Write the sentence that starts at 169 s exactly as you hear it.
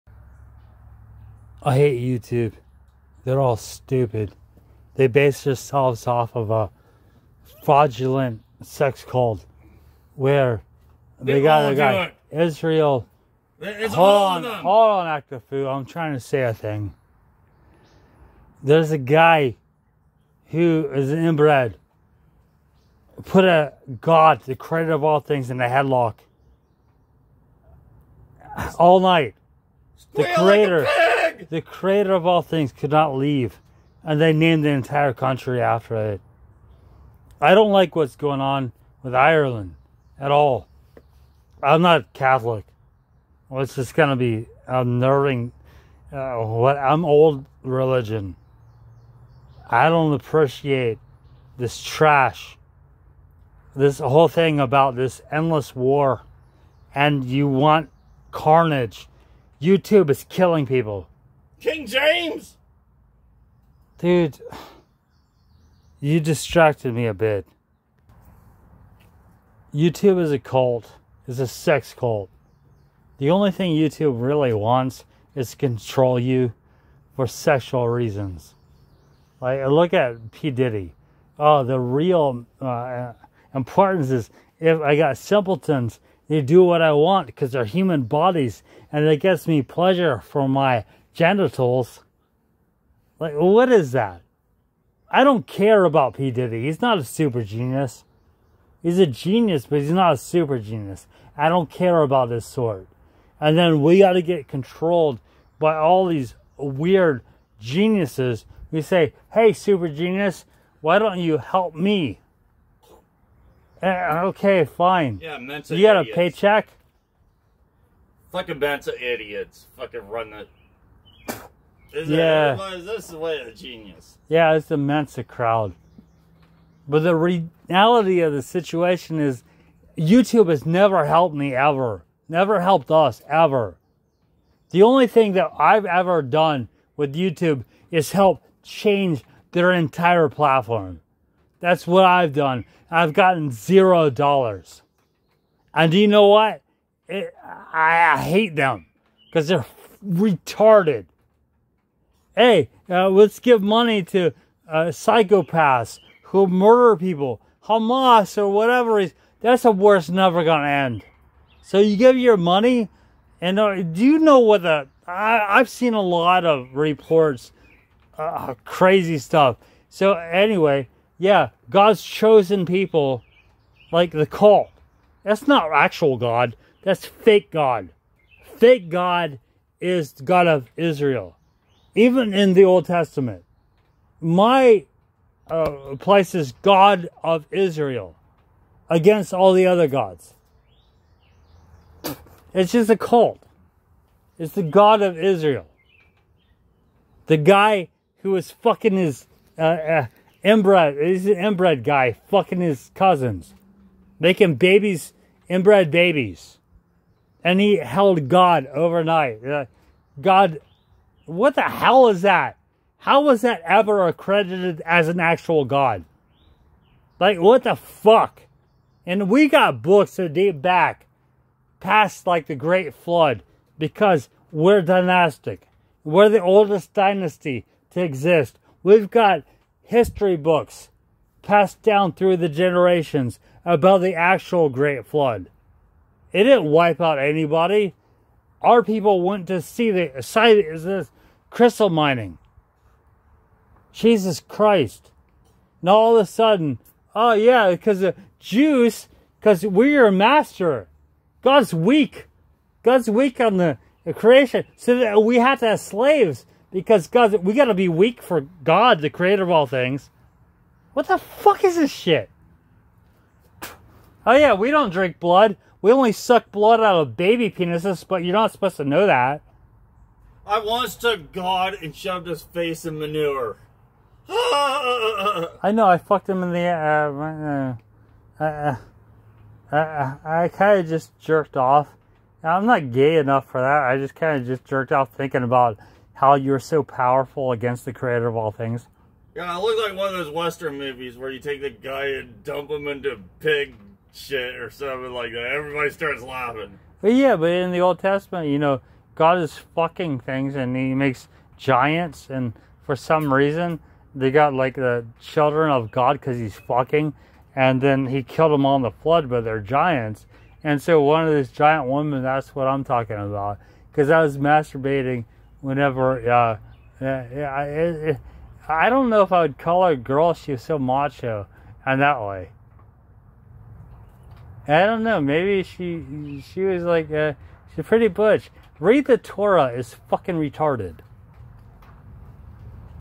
So anyway, yeah, God's chosen people, like the cult.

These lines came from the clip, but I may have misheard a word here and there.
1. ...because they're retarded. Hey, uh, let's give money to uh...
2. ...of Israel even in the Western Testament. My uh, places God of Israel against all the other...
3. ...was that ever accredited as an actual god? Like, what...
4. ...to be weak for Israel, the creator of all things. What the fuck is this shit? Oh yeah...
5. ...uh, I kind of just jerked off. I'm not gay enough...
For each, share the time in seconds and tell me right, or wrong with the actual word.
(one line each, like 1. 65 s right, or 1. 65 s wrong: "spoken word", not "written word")
1. 149 s right
2. 180 s wrong: "Old", not "Western"
3. 213 s right
4. 257 s wrong: "God", not "Israel"
5. 279 s right.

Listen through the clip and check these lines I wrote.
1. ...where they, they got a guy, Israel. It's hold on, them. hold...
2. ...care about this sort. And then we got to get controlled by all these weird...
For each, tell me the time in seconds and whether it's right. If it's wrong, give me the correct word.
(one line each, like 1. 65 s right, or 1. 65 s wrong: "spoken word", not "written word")
1. 10 s right
2. 101 s right.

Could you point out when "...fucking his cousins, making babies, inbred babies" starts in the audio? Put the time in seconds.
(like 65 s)
202 s.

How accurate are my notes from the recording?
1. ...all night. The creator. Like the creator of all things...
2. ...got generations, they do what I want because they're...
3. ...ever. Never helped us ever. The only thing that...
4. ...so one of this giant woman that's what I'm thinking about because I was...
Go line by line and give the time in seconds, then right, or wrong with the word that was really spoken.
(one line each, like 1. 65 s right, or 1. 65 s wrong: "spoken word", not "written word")
1. 28 s right
2. 84 s wrong: "simpletons", not "generations"
3. 131 s right
4. 310 s wrong: "talking", not "thinking".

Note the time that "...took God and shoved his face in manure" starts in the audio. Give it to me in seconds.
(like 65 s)
270 s.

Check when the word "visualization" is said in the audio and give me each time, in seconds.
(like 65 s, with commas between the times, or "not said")
not said.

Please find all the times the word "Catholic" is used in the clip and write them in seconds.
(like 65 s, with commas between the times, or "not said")
42 s.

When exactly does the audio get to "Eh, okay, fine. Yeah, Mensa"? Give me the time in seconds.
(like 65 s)
113 s.